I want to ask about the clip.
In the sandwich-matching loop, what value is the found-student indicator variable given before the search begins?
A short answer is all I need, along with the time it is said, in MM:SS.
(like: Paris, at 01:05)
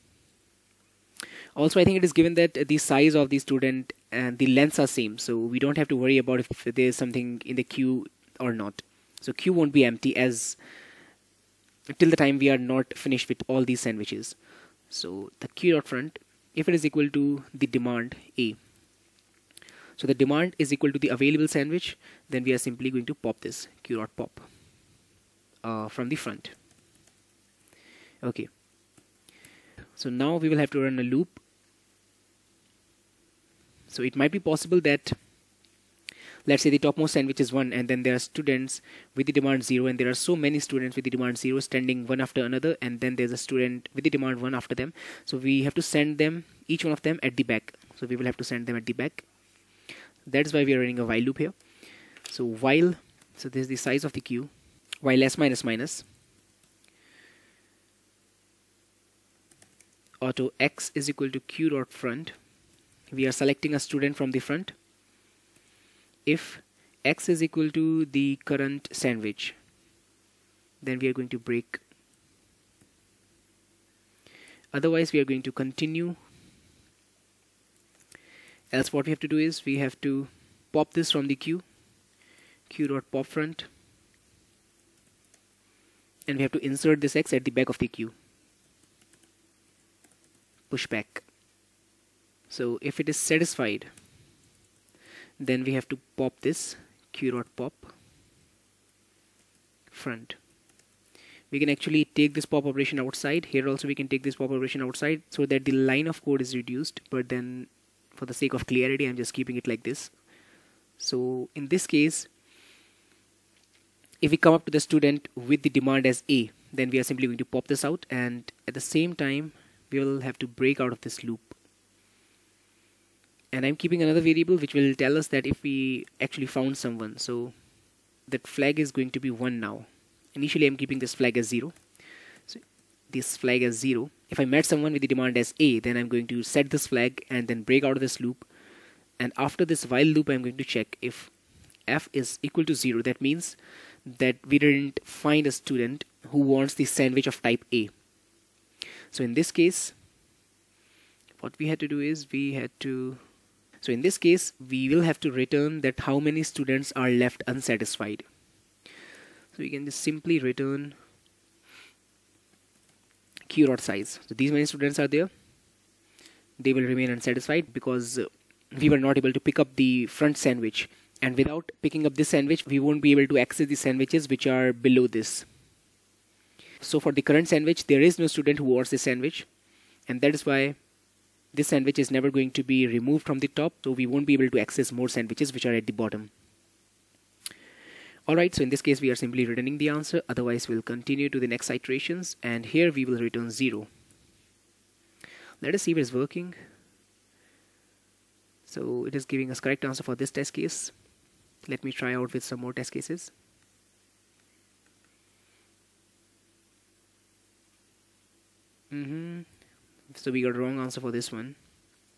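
0, at 02:10.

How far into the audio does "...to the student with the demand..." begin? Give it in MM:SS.
01:54.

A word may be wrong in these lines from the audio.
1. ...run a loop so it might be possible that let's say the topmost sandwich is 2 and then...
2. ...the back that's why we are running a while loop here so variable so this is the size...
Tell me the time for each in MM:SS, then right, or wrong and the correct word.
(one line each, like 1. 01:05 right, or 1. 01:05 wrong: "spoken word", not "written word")
1. 00:30 wrong: "1", not "2"
2. 00:48 wrong: "while", not "variable".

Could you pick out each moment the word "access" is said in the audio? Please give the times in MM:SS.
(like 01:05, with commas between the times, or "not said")
02:53, 03:04.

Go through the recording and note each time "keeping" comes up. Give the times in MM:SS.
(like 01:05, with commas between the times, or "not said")
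01:49, 02:03, 02:10.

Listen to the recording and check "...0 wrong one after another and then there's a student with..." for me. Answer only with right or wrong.
wrong.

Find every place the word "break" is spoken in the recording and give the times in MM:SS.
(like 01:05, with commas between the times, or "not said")
01:11, 02:00, 02:17.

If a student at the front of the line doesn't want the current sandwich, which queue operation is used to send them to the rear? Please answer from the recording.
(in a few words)
push back.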